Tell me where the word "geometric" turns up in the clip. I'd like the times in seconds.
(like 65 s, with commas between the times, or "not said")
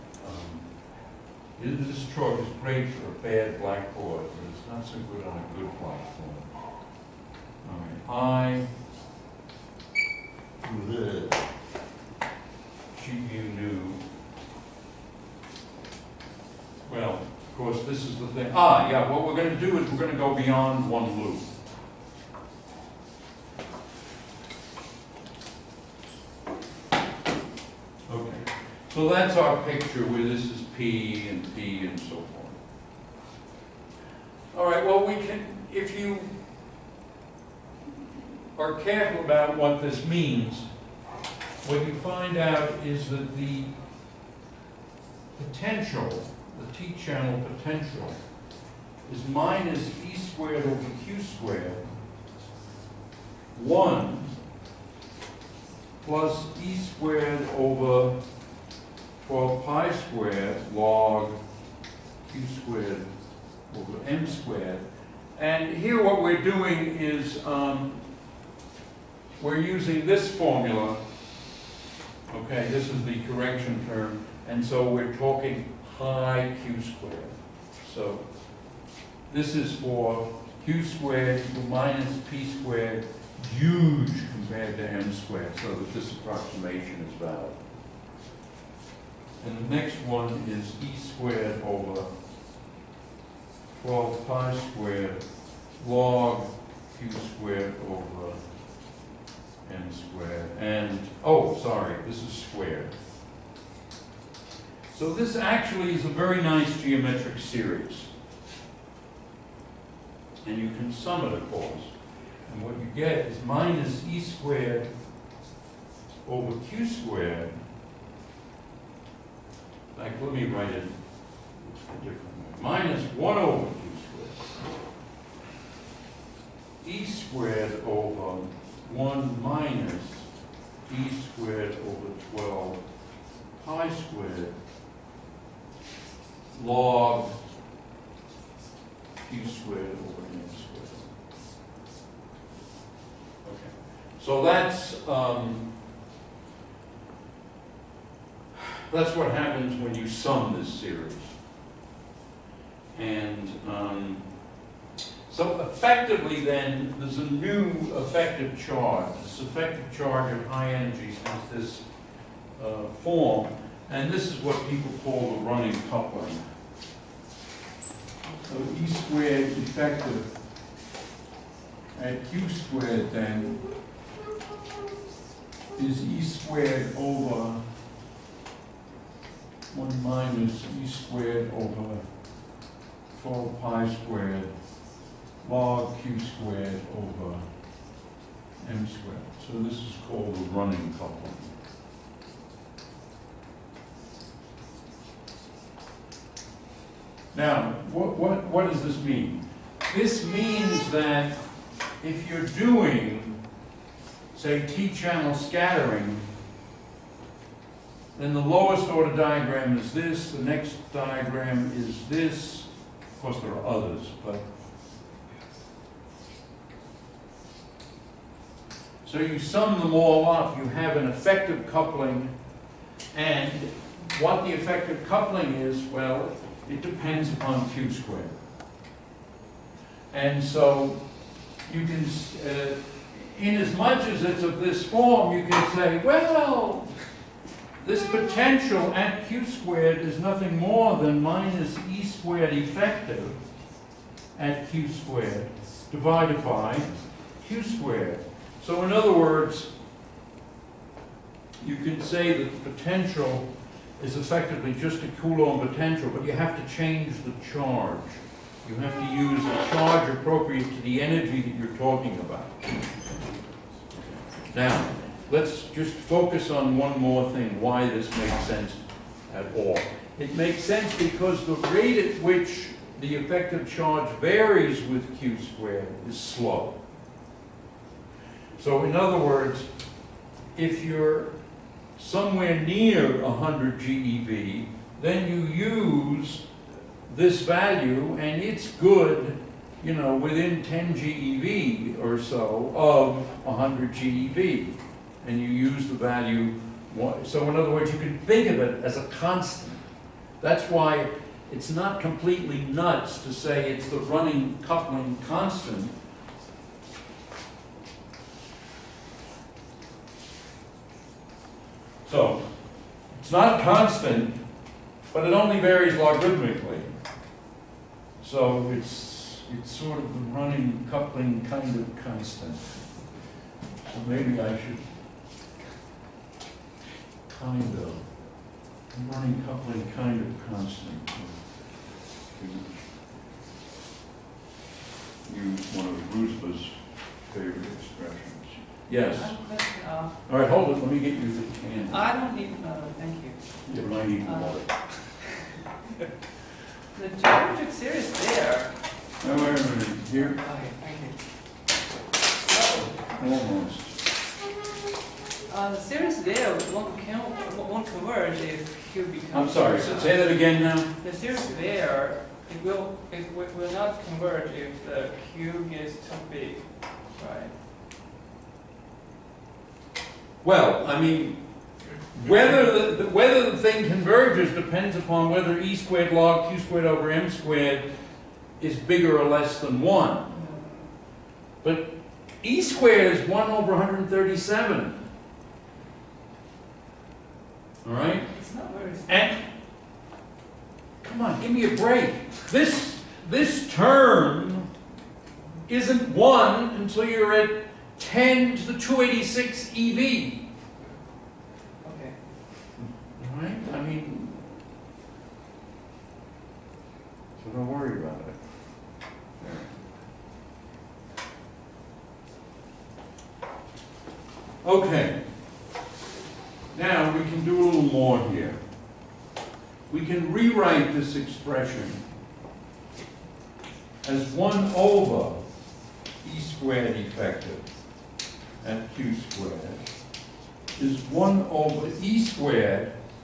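106 s, 347 s.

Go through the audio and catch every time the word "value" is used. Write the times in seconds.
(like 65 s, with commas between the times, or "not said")
287 s, 295 s.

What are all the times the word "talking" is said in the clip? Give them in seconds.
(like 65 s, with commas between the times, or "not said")
75 s, 261 s.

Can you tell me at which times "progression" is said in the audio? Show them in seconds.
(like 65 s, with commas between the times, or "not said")
not said.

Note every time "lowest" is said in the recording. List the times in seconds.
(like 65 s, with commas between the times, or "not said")
208 s.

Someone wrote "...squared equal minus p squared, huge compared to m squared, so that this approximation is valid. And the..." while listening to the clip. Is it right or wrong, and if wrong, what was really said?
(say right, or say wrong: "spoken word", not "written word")
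right.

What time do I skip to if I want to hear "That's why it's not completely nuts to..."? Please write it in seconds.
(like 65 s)
300 s.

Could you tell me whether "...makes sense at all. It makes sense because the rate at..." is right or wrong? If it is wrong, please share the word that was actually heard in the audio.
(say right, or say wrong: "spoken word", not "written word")
right.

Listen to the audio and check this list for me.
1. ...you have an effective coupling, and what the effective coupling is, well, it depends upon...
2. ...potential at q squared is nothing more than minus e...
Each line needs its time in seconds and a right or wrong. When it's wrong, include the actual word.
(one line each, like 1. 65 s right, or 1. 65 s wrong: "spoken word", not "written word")
1. 220 s right
2. 238 s right.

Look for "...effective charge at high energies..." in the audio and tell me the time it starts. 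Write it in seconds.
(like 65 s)
159 s.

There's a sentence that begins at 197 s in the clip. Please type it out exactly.
Now, what, what, what does this mean?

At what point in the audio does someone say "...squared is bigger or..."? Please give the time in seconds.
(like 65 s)
377 s.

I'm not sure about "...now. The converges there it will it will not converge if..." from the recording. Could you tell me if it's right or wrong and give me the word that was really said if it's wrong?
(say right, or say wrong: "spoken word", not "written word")
wrong: "series", not "converges".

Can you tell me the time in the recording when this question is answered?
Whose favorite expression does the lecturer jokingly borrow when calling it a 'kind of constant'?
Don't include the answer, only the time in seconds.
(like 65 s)
336 s.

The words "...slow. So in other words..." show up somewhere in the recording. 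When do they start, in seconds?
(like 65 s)
276 s.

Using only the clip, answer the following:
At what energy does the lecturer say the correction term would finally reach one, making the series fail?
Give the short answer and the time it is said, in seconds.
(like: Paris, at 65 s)
10^286 eV, at 397 s.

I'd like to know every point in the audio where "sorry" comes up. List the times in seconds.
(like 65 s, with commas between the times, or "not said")
101 s, 359 s.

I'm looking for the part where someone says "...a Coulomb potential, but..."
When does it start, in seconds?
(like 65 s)
255 s.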